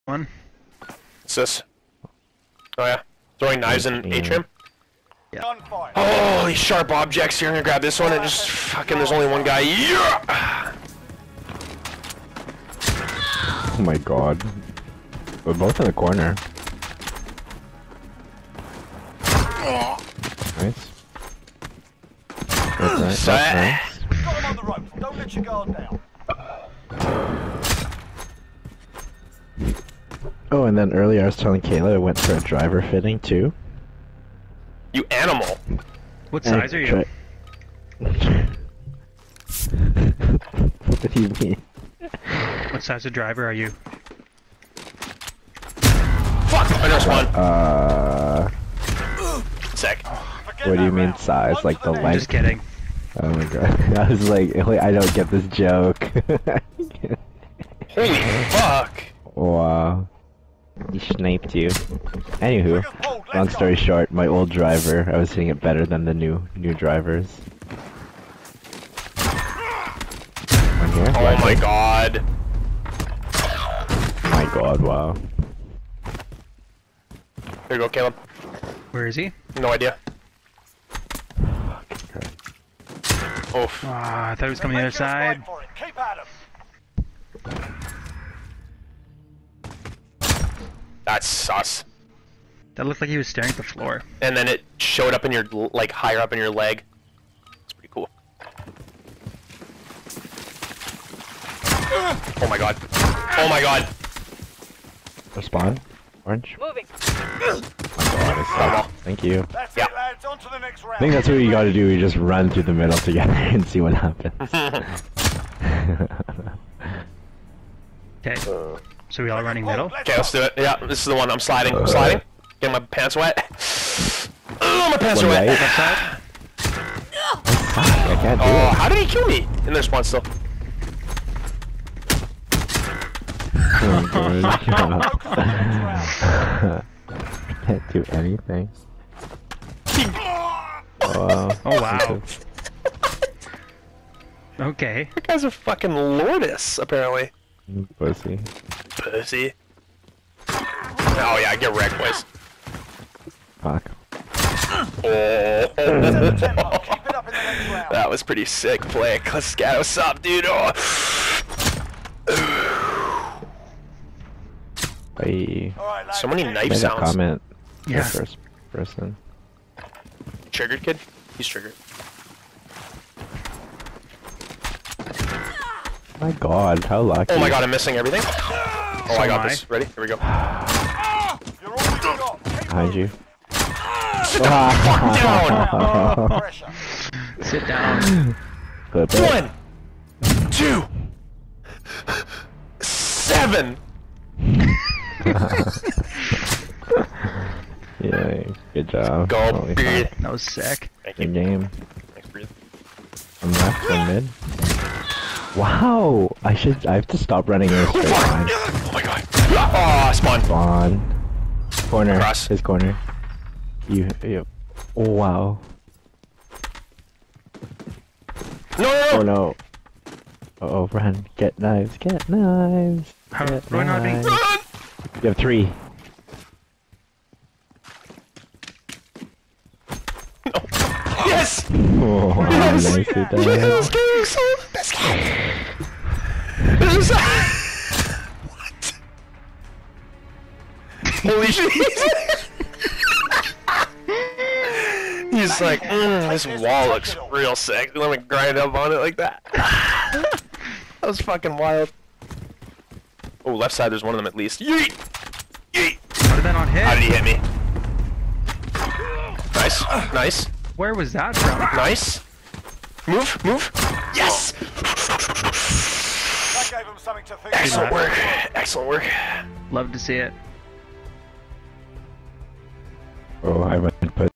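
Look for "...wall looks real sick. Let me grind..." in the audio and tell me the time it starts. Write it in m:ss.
4:06.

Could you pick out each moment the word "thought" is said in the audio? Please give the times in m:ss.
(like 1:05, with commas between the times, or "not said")
1:24.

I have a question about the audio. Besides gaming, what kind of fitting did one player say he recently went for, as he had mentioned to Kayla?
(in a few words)
Driver fitting.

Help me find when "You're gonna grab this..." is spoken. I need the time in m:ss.
0:07.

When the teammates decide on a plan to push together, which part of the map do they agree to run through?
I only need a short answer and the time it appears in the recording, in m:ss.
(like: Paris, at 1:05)
The middle, at 1:52.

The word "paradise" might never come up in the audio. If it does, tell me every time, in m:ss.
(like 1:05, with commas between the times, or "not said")
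not said.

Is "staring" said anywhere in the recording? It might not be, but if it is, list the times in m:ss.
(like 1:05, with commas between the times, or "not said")
1:33.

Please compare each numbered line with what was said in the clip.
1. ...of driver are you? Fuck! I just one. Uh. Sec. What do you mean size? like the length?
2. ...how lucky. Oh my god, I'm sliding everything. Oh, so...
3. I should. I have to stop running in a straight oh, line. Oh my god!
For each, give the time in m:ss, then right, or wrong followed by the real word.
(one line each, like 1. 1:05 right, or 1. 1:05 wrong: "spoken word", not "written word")
1. 0:43 right
2. 2:56 wrong: "missing", not "sliding"
3. 3:26 right.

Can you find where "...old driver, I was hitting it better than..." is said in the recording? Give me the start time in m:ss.
1:04.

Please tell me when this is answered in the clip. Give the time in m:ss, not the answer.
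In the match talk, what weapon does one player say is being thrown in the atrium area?
0:03.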